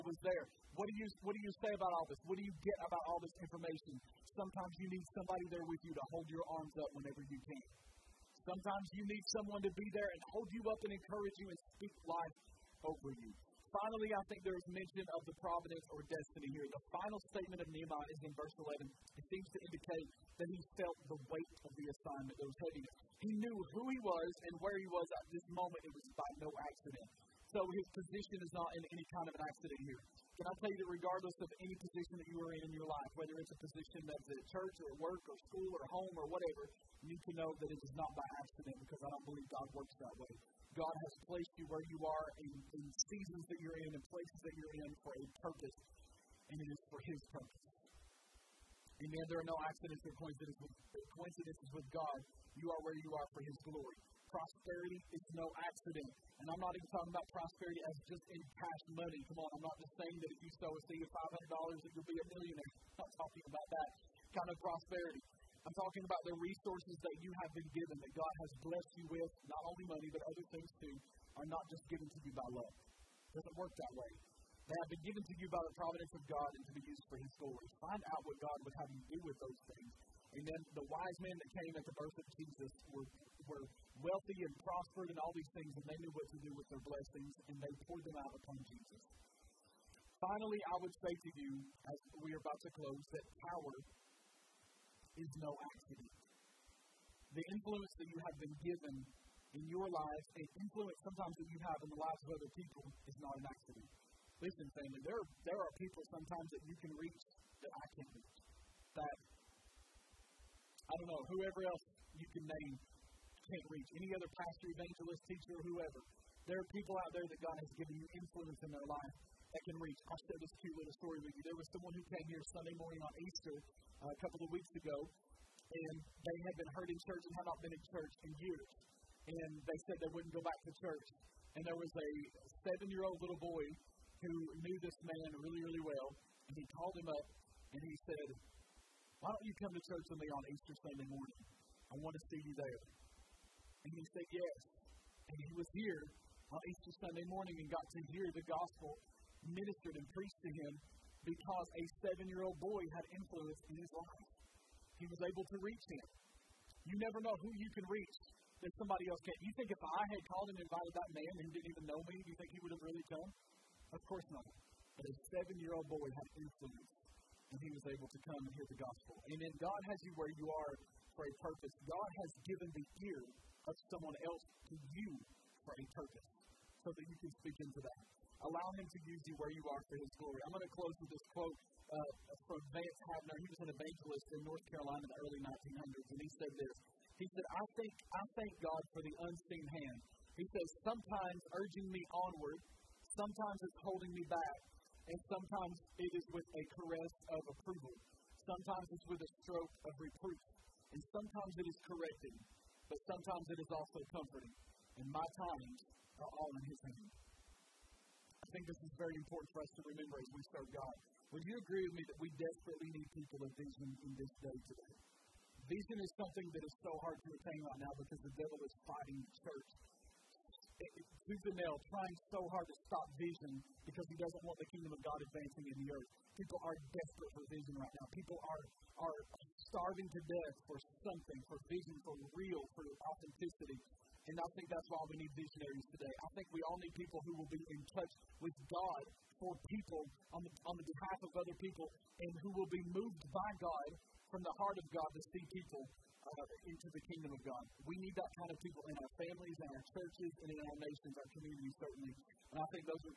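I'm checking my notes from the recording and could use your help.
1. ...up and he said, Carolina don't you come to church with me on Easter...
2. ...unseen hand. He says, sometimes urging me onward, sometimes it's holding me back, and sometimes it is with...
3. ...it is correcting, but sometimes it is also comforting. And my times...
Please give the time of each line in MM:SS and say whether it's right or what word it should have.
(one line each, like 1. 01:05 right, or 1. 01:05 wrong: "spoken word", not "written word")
1. 02:17 wrong: "Why", not "Carolina"
2. 03:09 right
3. 03:21 right.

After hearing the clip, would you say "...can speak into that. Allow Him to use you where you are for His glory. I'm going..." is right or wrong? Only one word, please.
right.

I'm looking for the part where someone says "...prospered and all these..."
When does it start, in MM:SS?
01:24.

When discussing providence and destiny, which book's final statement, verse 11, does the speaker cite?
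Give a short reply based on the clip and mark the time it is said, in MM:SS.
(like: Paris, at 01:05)
Nehemiah, at 00:17.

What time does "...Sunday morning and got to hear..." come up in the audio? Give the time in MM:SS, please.
02:27.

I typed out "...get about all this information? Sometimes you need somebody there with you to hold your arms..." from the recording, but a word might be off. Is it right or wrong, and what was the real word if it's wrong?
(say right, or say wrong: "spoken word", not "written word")
right.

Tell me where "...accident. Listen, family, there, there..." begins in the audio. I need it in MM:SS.
01:43.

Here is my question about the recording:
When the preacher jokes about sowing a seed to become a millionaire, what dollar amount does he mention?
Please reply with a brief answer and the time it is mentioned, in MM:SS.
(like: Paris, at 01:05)
$500, at 01:01.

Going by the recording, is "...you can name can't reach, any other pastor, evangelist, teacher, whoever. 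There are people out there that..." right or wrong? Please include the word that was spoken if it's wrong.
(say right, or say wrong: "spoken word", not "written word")
right.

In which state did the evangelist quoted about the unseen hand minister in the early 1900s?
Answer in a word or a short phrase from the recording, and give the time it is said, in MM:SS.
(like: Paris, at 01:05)
North Carolina, at 03:04.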